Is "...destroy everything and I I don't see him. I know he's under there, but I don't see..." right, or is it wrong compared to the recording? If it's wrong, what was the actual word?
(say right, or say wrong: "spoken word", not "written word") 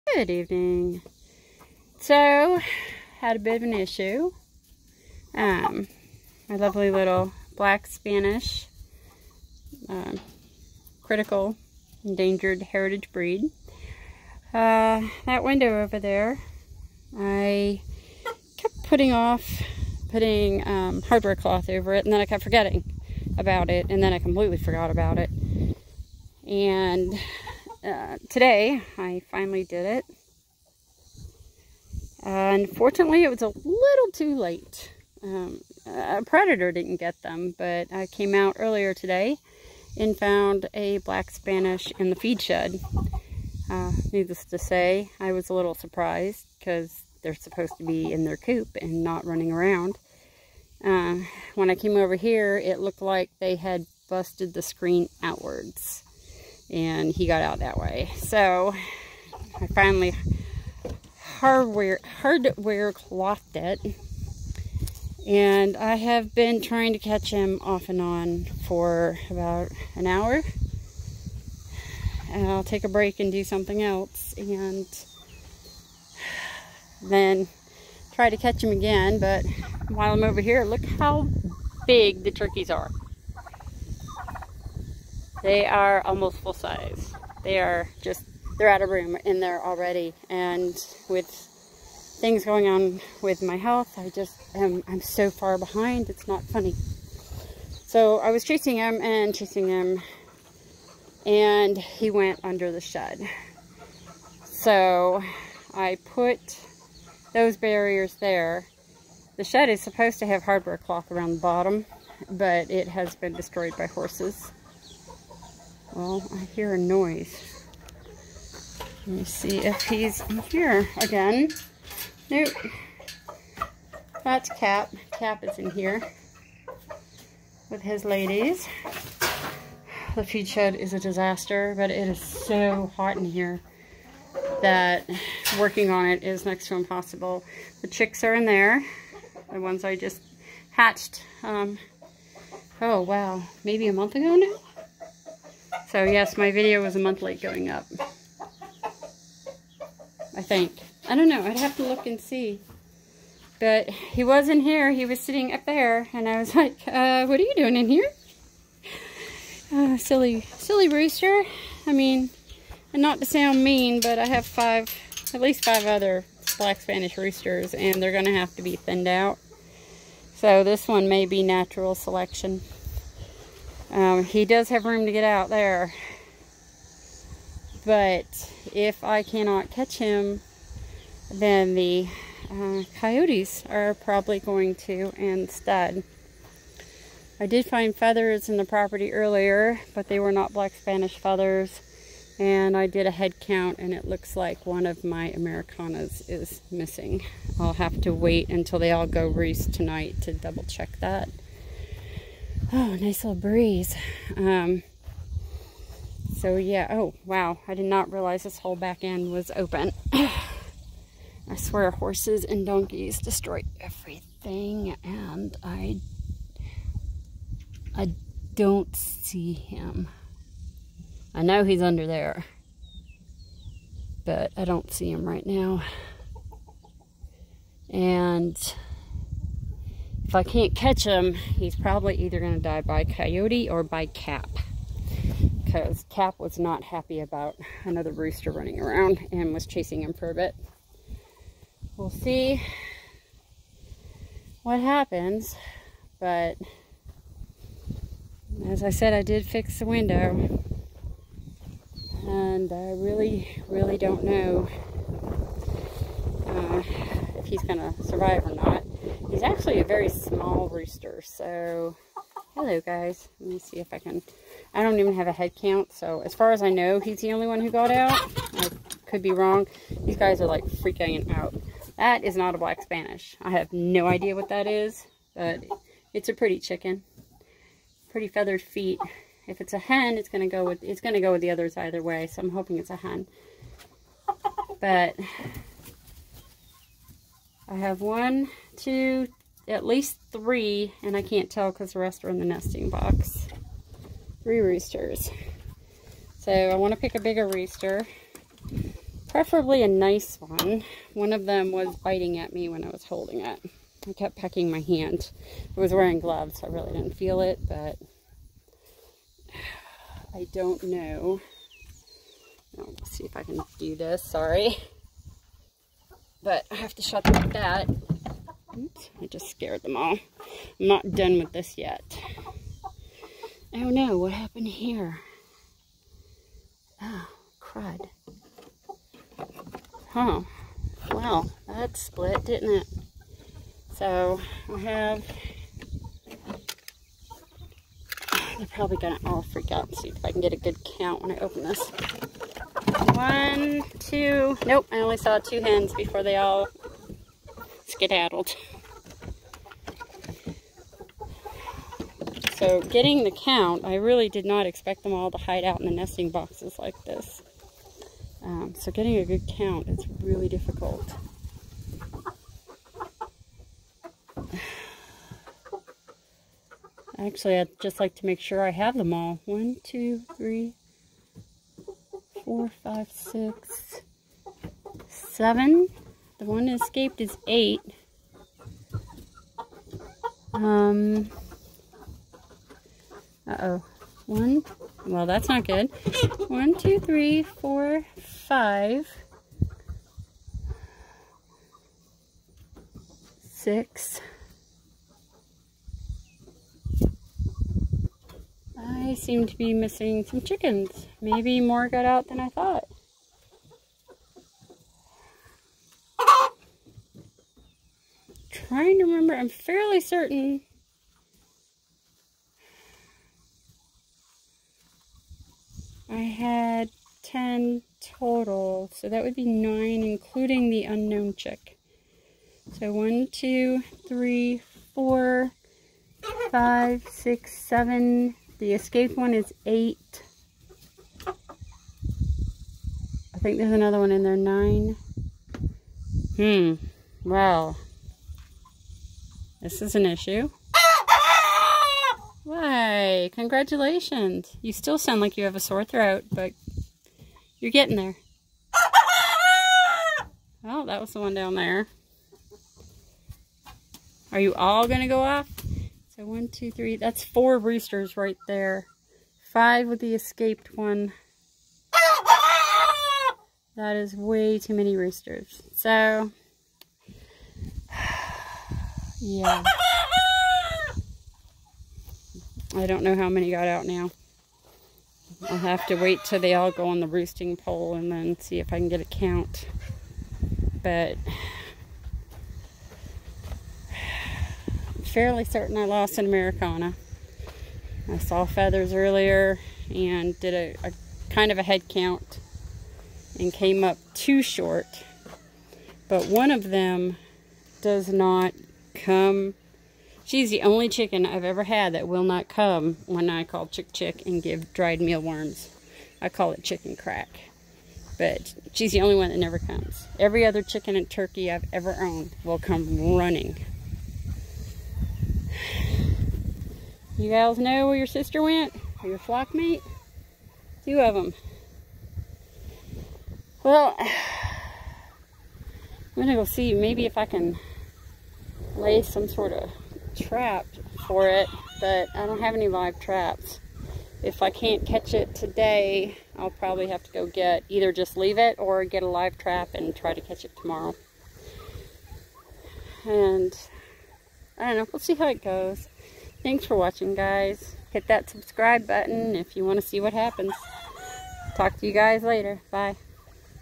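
right.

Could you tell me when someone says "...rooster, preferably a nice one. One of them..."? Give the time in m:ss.
4:57.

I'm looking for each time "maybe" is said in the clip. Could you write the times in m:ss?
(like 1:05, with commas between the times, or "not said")
2:23, 6:41, 8:46.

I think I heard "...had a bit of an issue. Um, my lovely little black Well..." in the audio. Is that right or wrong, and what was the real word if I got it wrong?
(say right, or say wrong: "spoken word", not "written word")
wrong: "Spanish", not "Well".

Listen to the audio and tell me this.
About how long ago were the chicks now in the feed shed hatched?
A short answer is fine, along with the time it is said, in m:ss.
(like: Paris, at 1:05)
A month ago, at 2:23.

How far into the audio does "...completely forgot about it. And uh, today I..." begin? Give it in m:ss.
0:24.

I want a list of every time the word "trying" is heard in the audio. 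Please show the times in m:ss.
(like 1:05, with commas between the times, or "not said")
1:06, 6:48.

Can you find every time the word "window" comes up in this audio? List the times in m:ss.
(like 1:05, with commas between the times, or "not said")
0:15, 4:09.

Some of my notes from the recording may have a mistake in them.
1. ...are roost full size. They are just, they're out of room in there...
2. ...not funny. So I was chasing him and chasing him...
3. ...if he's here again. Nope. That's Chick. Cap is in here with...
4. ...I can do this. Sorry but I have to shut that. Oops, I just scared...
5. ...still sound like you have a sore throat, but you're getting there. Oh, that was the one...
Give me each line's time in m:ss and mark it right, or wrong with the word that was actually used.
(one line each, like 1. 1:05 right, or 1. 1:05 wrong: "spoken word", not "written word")
1. 1:25 wrong: "almost", not "roost"
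2. 1:36 right
3. 1:59 wrong: "Cap", not "Chick"
4. 5:13 right
5. 7:24 right.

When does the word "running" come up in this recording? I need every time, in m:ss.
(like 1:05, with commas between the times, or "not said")
0:49, 3:58, 8:33.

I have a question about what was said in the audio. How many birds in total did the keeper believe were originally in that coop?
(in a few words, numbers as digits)
10.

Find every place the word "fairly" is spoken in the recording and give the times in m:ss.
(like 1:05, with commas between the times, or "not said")
6:49, 8:05.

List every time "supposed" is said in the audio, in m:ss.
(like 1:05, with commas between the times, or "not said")
0:47, 1:49.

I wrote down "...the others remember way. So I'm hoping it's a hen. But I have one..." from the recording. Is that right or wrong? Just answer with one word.
wrong.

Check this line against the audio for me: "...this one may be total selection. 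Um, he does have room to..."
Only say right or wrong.
wrong.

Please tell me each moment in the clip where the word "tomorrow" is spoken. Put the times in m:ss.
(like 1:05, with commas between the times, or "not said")
9:00.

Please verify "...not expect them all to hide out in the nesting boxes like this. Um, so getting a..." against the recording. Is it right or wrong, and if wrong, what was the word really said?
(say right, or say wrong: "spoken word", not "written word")
right.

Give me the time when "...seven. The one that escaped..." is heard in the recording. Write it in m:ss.
6:15.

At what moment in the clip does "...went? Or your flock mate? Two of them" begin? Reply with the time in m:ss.
8:38.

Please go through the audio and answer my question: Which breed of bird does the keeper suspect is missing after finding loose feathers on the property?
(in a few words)
Americana.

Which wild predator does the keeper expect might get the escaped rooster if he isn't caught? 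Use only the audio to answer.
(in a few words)
Coyotes.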